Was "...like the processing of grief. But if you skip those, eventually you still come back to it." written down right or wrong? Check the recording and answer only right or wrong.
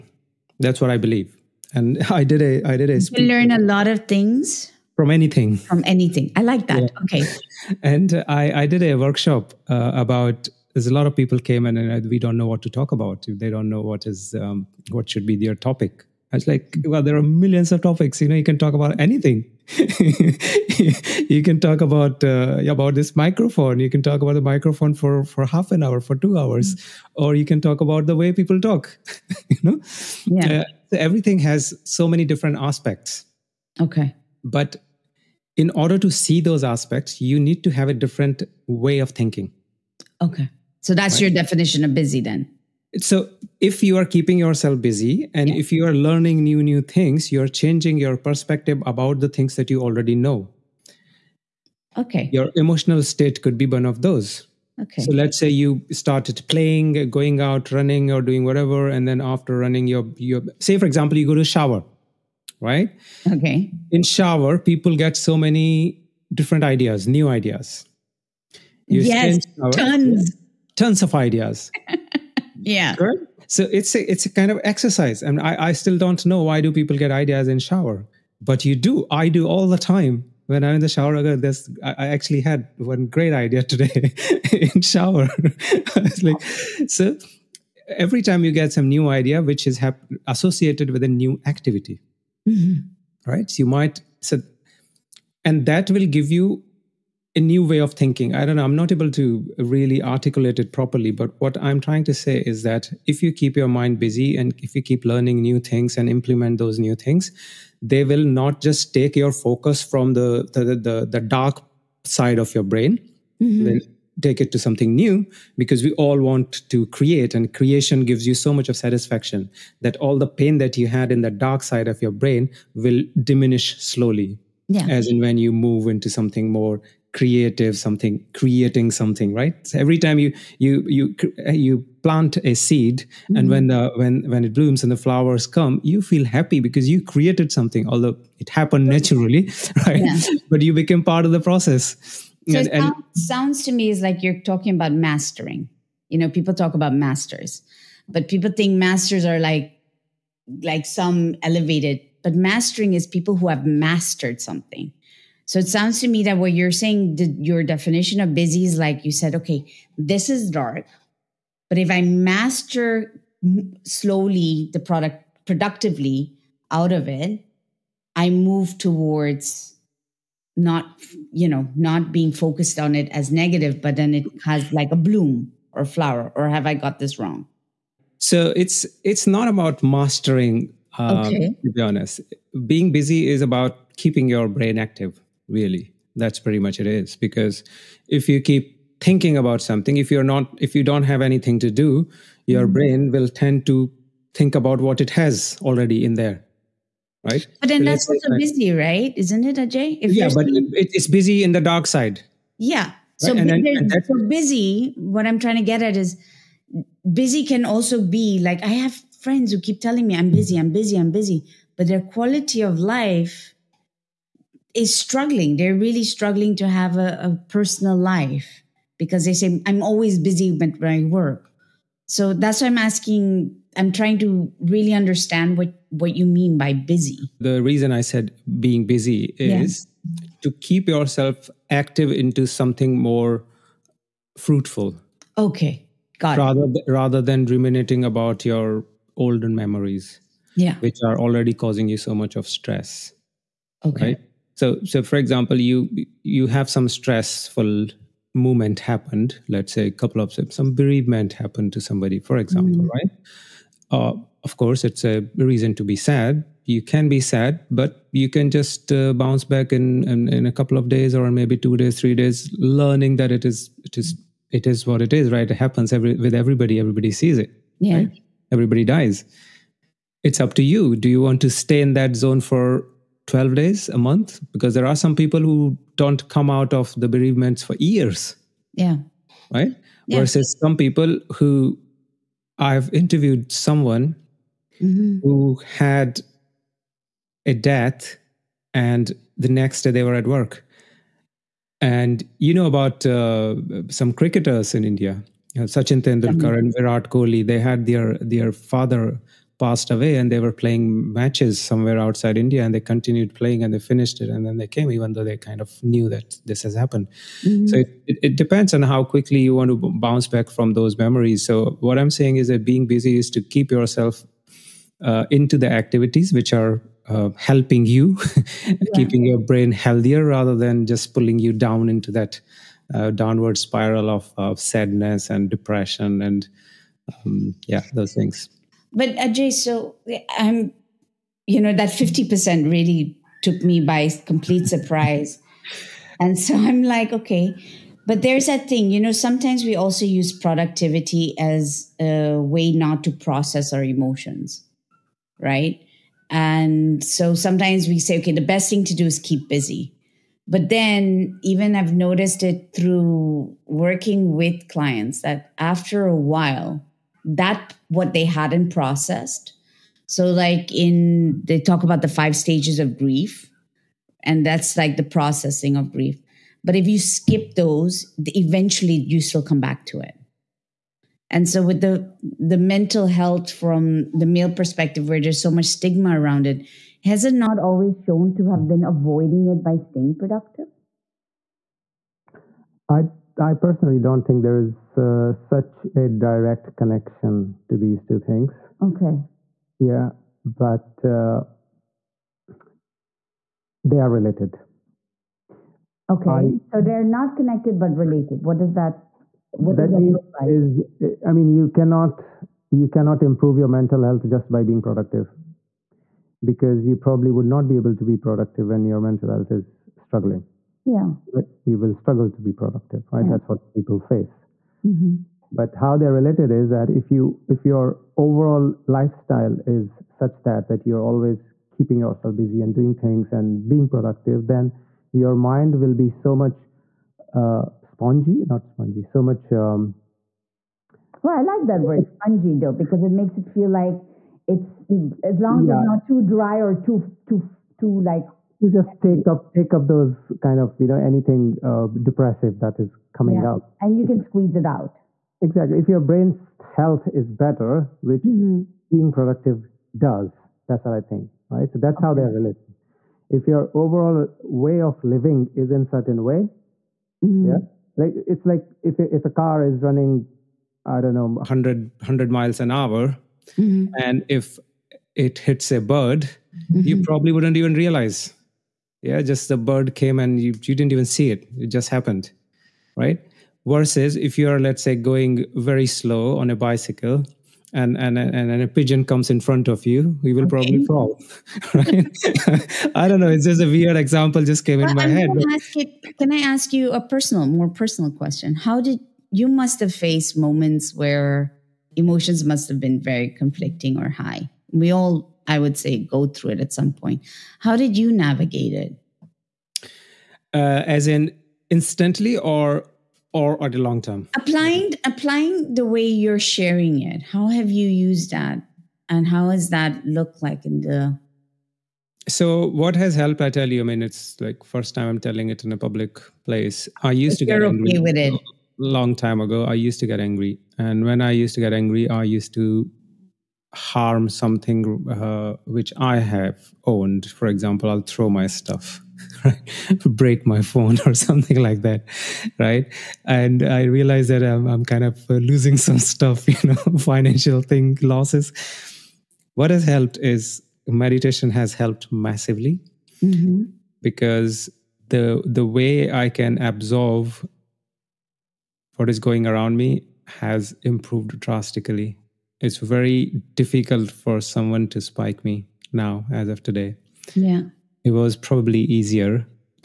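right.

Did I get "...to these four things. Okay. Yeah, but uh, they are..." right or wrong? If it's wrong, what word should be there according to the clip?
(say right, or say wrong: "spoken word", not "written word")
wrong: "two", not "four".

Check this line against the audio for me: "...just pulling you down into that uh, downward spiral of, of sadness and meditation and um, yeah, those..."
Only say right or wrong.
wrong.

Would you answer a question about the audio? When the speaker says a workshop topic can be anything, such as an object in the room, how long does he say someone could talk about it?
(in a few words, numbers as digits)
two hours.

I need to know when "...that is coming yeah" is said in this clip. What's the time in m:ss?
7:22.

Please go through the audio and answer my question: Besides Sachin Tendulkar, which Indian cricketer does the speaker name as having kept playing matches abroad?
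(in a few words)
Virat Kohli.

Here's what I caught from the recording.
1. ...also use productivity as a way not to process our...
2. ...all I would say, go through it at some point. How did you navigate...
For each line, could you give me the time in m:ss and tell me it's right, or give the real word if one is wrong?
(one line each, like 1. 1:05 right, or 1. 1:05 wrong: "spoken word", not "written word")
1. 5:39 right
2. 8:14 right.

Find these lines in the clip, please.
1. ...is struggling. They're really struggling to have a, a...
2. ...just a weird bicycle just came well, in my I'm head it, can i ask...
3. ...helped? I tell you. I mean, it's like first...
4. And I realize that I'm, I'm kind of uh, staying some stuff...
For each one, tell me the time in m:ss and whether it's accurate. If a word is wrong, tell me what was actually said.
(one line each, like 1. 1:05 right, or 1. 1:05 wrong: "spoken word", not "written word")
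1. 3:34 right
2. 8:03 wrong: "example", not "bicycle"
3. 8:33 right
4. 8:53 wrong: "losing", not "staying".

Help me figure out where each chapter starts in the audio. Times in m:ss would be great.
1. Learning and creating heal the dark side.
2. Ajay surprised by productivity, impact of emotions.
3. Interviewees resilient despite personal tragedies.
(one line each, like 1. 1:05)
1. 1:37
2. 5:28
3. 4:38.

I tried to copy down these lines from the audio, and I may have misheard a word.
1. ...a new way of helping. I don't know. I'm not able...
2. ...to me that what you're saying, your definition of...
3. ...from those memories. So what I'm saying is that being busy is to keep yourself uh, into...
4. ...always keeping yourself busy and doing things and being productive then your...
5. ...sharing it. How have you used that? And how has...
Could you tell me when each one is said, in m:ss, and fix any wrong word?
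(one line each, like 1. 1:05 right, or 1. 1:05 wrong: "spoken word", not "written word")
1. 1:37 wrong: "thinking", not "helping"
2. 2:36 right
3. 5:10 right
4. 7:01 right
5. 8:26 right.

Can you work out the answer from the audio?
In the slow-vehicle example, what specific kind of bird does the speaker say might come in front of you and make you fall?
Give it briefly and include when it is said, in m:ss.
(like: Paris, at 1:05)
pigeon, at 7:58.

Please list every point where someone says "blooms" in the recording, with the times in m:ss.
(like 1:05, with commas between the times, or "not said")
2:14, 2:54.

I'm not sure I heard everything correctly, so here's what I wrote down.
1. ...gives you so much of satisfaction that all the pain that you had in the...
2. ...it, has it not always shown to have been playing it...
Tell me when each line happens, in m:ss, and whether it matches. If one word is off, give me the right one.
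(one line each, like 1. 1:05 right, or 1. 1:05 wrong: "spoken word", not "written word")
1. 1:58 right
2. 6:16 wrong: "avoiding", not "playing".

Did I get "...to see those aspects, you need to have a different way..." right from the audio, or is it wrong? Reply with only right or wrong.
right.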